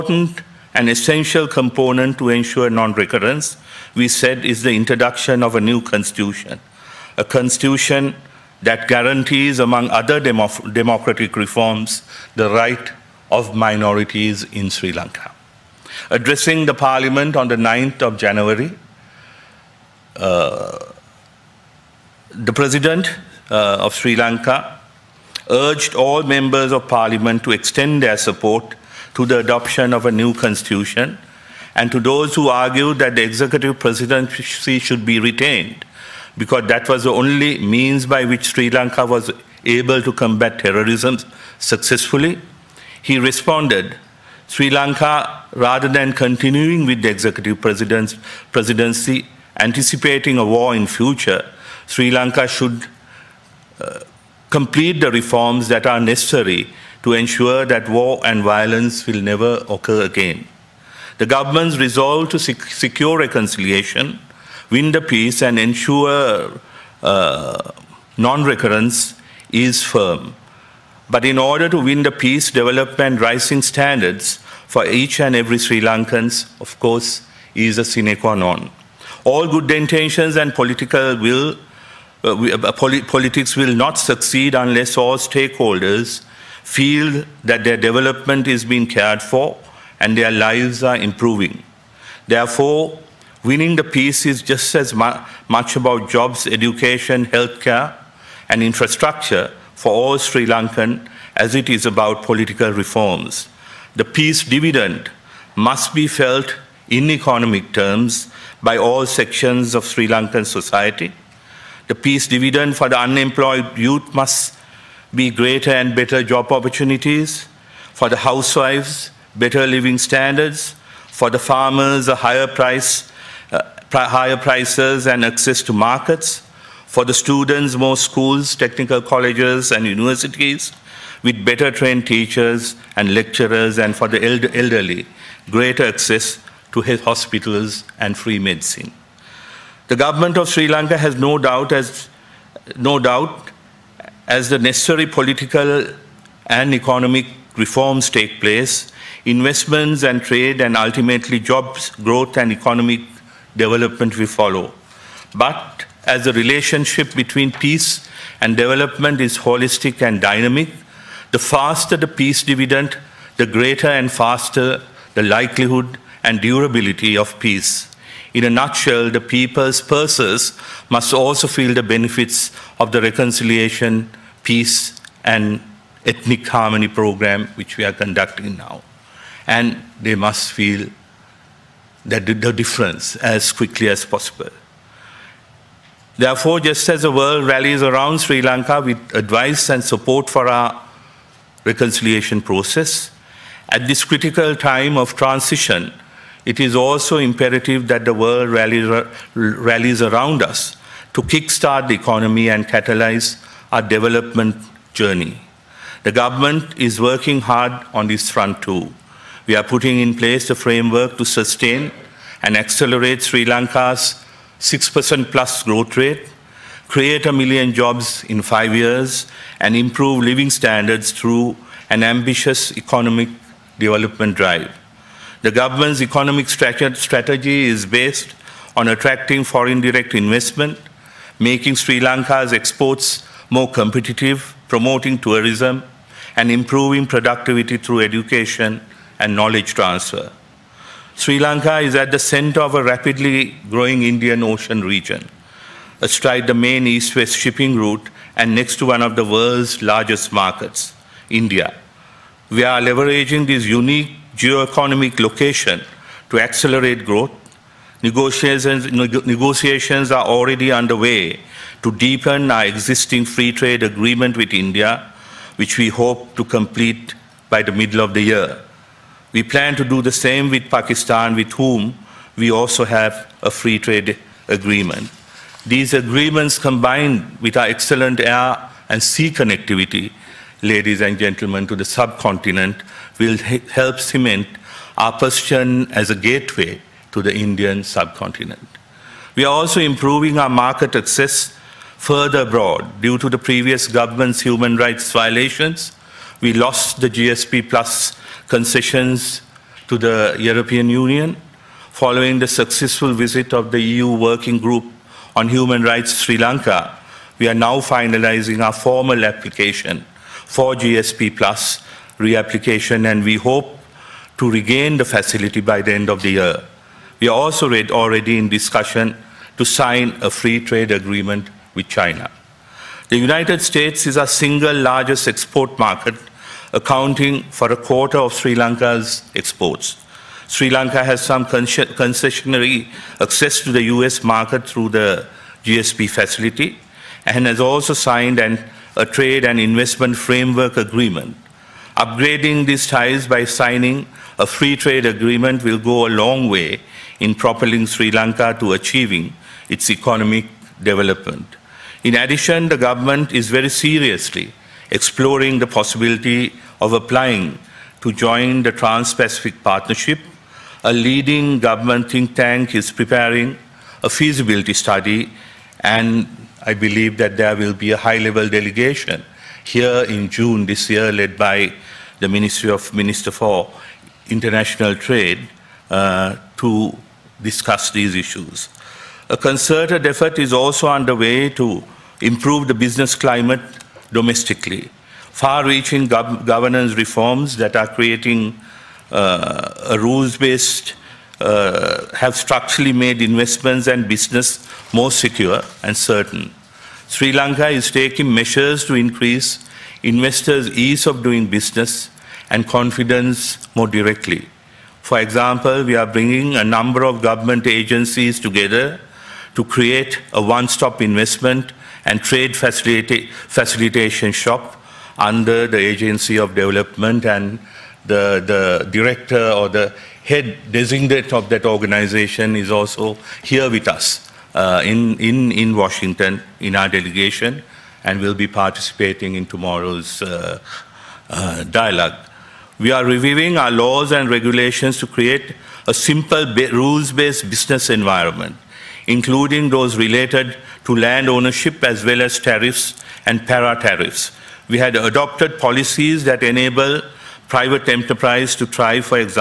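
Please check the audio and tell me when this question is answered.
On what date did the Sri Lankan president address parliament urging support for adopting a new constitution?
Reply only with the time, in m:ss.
0:17.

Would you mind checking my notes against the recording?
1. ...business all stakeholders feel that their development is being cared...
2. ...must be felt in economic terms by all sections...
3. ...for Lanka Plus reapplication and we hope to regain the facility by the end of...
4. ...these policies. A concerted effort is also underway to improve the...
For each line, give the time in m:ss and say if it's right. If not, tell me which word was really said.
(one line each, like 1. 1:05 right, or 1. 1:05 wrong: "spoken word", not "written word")
1. 1:24 wrong: "unless", not "business"
2. 1:45 right
3. 5:10 wrong: "GSP", not "Lanka"
4. 6:17 wrong: "issues", not "policies".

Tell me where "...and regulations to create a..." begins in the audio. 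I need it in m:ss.
7:14.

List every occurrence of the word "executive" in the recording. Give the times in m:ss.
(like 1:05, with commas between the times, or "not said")
0:33, 0:47.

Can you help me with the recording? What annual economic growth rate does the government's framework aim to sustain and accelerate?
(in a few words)
6% plus.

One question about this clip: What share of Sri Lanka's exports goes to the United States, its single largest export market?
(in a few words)
a quarter.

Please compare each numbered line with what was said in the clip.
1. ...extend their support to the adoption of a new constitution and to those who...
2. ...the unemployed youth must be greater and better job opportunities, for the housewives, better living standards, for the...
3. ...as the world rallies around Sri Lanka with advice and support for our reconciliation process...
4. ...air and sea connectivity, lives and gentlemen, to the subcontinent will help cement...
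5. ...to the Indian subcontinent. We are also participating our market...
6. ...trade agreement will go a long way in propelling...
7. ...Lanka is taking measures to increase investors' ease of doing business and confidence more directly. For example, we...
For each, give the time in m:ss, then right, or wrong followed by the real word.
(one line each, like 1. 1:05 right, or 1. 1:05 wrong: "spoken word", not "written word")
1. 0:27 right
2. 1:52 right
3. 3:06 right
4. 4:38 wrong: "ladies", not "lives"
5. 4:47 wrong: "improving", not "participating"
6. 5:44 right
7. 6:37 right.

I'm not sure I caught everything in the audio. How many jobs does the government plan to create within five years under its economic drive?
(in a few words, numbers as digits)
a million.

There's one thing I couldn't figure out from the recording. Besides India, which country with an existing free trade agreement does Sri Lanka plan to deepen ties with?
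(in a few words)
Pakistan.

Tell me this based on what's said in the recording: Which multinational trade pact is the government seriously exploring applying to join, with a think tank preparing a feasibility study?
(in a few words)
Trans-Pacific Partnership.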